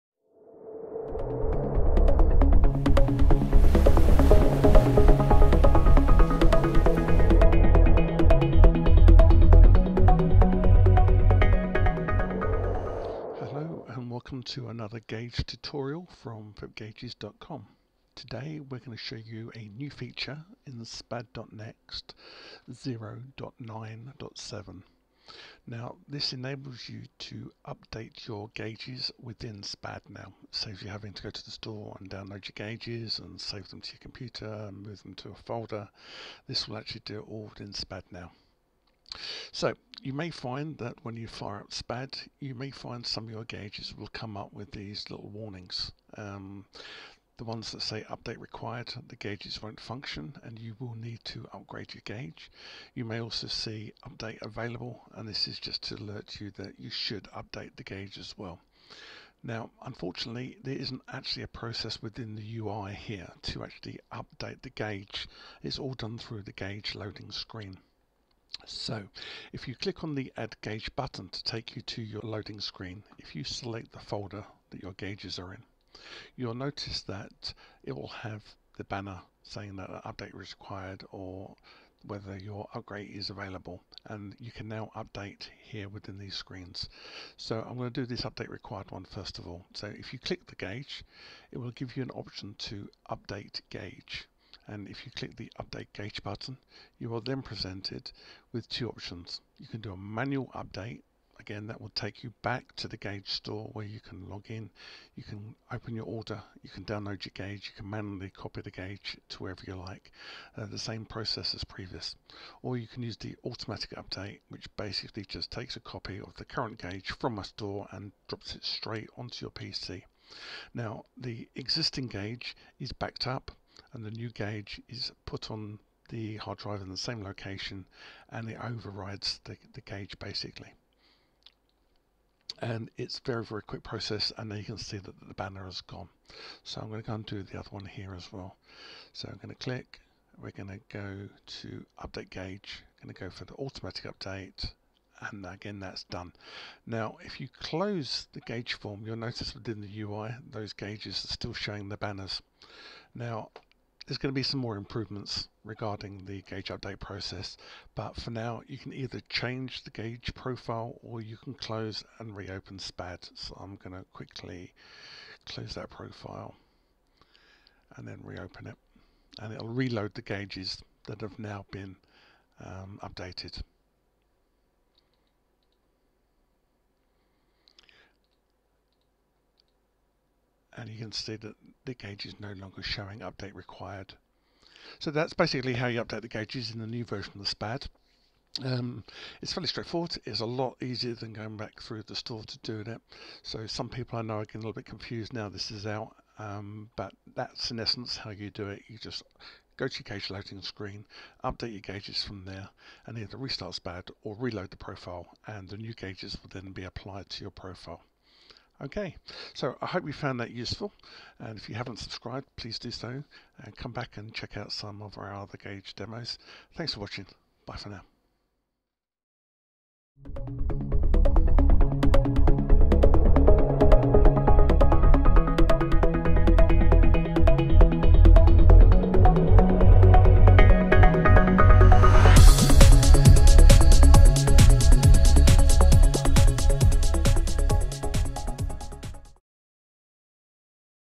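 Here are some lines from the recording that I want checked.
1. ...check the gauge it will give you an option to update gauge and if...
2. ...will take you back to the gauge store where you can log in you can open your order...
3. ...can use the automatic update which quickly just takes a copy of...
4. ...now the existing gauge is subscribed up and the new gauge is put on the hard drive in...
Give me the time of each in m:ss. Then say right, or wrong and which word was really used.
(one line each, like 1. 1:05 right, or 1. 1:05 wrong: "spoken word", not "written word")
1. 1:30 wrong: "click", not "check"
2. 1:41 right
3. 1:52 wrong: "basically", not "quickly"
4. 2:00 wrong: "backed", not "subscribed".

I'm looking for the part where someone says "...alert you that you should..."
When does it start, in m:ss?
0:55.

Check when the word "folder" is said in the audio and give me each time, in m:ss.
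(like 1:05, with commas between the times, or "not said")
0:35, 1:13.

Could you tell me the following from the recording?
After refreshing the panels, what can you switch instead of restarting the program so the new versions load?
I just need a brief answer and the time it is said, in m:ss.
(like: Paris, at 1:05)
the gauge profile, at 2:39.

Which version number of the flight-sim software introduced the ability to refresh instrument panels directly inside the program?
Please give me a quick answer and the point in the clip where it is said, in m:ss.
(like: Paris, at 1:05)
0.9.7, at 0:22.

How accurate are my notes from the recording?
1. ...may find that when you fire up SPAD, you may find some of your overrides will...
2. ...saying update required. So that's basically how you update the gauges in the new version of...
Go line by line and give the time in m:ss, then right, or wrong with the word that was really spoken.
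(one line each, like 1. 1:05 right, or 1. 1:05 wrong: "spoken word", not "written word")
1. 0:40 wrong: "gauges", not "overrides"
2. 3:02 wrong: "showing", not "saying".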